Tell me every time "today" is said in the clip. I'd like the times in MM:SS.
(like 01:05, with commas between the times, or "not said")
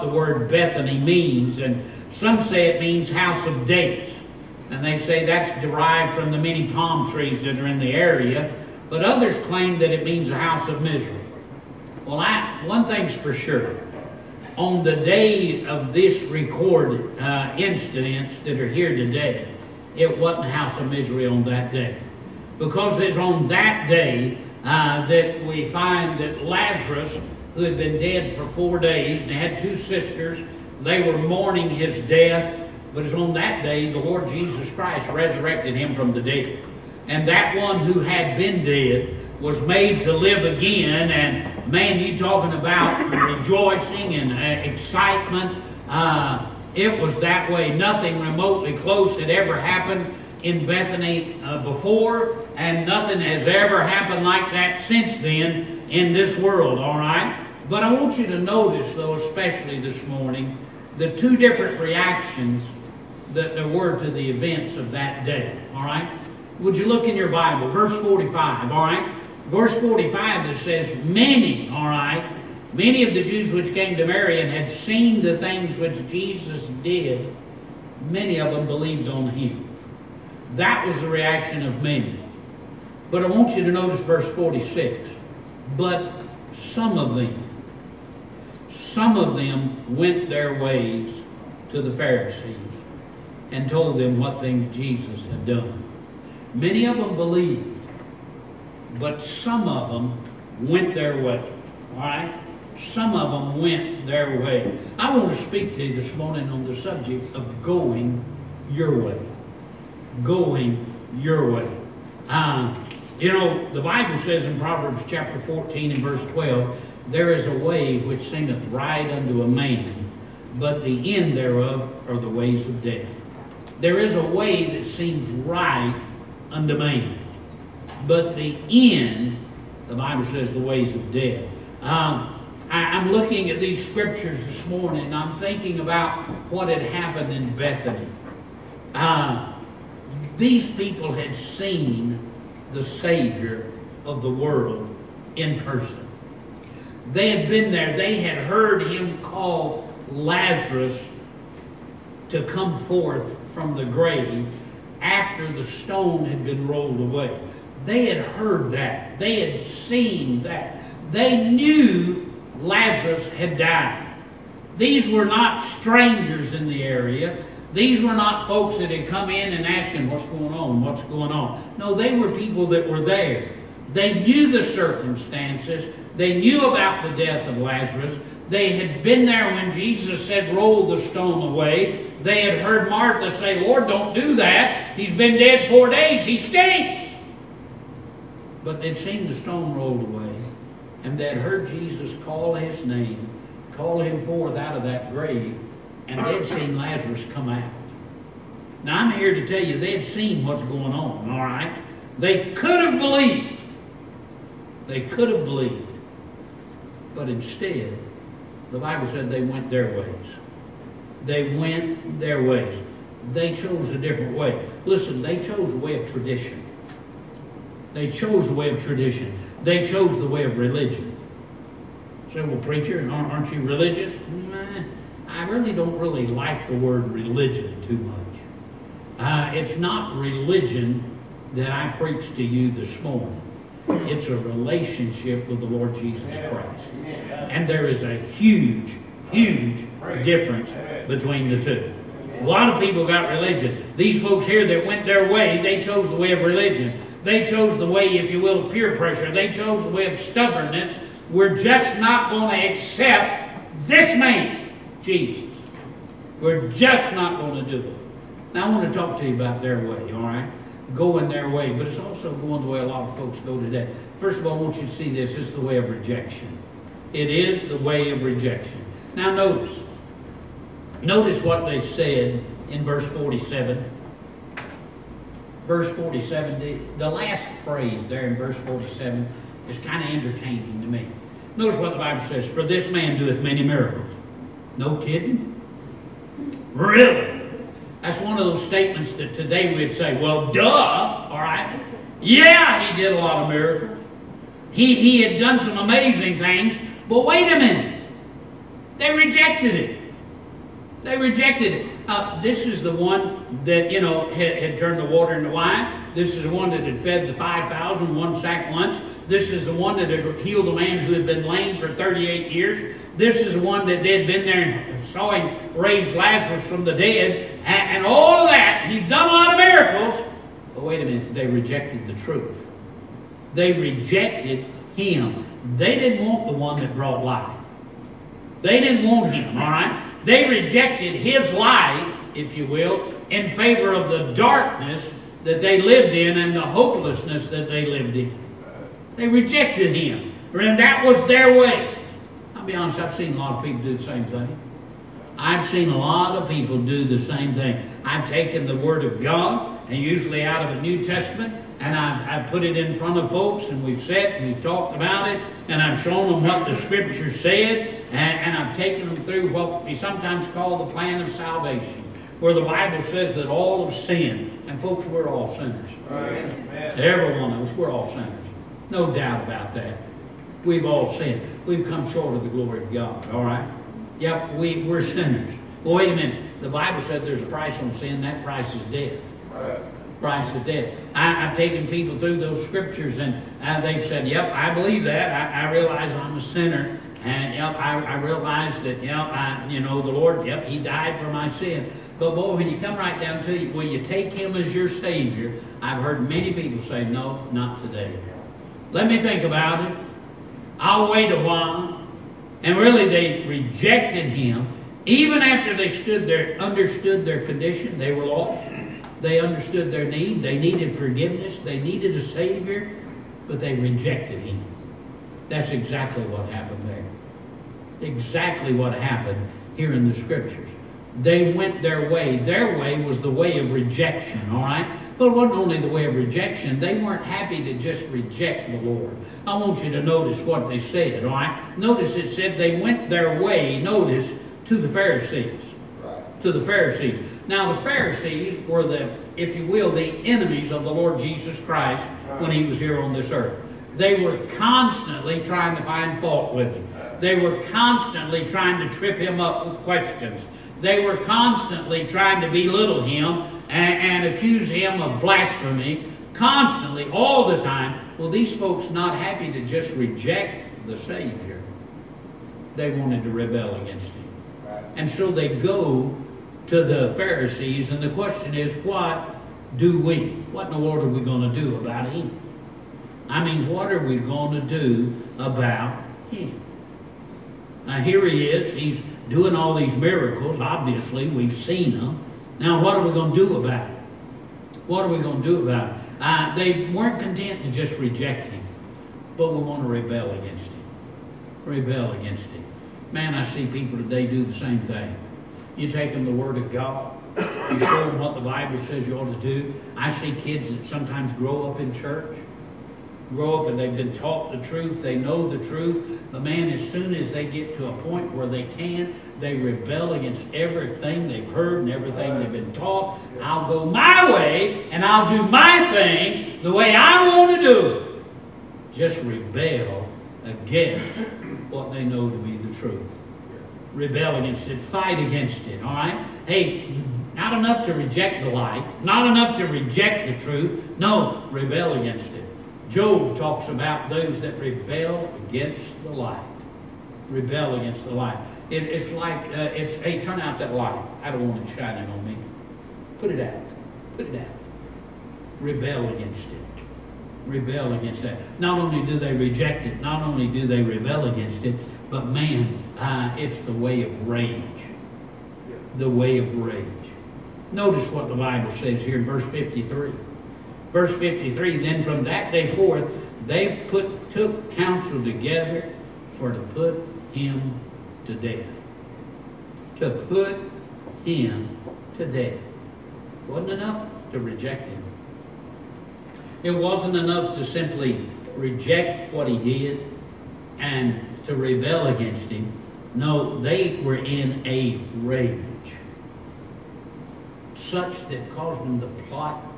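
00:18, 04:23, 04:49, 06:37, 08:13.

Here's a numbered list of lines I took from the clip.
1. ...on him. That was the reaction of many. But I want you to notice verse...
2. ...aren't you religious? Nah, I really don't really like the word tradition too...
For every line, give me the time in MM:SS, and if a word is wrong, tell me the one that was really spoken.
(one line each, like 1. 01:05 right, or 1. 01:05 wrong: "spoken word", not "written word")
1. 01:19 right
2. 03:43 wrong: "religion", not "tradition".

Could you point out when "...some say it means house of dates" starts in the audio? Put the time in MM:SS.
00:02.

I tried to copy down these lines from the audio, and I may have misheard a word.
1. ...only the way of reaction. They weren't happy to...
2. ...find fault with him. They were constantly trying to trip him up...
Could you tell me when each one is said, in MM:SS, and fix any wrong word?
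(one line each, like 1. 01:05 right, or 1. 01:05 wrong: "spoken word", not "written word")
1. 07:05 wrong: "rejection", not "reaction"
2. 07:25 right.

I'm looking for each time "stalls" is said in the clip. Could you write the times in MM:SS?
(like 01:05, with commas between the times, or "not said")
not said.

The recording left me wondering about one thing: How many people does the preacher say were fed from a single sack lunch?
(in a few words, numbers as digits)
5,000.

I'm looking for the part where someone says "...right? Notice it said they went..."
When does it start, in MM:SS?
07:11.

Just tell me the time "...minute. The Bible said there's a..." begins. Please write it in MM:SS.
06:16.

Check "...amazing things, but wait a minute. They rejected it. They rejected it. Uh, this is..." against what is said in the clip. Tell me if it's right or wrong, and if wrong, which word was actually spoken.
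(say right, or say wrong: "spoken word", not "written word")
right.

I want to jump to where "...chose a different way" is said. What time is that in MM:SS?
03:33.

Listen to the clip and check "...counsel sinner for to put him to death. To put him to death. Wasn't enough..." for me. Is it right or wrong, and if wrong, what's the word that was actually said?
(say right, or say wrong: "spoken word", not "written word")
wrong: "together", not "sinner".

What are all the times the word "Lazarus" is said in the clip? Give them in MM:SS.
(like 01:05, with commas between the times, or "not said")
00:26, 02:30, 02:42, 02:57, 03:16, 05:16.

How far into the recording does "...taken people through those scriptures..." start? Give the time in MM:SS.
06:21.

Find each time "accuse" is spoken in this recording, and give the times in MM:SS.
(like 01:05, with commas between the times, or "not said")
07:34.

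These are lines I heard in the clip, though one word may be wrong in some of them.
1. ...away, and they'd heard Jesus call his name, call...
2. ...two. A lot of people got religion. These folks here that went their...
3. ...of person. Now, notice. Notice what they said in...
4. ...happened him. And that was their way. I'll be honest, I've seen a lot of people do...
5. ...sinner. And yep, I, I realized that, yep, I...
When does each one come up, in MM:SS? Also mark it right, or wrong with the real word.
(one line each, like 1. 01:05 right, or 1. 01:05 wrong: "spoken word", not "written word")
1. 03:09 right
2. 04:01 right
3. 04:28 wrong: "rejection", not "person"
4. 05:39 wrong: "rejected", not "happened"
5. 06:26 right.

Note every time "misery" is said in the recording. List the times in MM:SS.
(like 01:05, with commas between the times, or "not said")
00:10, 00:20.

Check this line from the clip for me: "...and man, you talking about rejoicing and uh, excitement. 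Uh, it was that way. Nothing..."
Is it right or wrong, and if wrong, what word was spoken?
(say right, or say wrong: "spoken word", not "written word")
right.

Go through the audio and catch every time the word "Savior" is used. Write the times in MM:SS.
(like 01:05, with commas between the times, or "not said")
02:22, 06:34, 06:52, 07:40.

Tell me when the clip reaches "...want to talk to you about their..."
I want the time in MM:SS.
04:18.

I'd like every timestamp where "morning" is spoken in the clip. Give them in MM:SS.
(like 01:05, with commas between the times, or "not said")
01:00, 01:46, 02:14, 03:52.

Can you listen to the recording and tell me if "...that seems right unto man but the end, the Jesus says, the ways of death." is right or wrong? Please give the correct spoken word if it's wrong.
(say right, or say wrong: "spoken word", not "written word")
wrong: "Bible", not "Jesus".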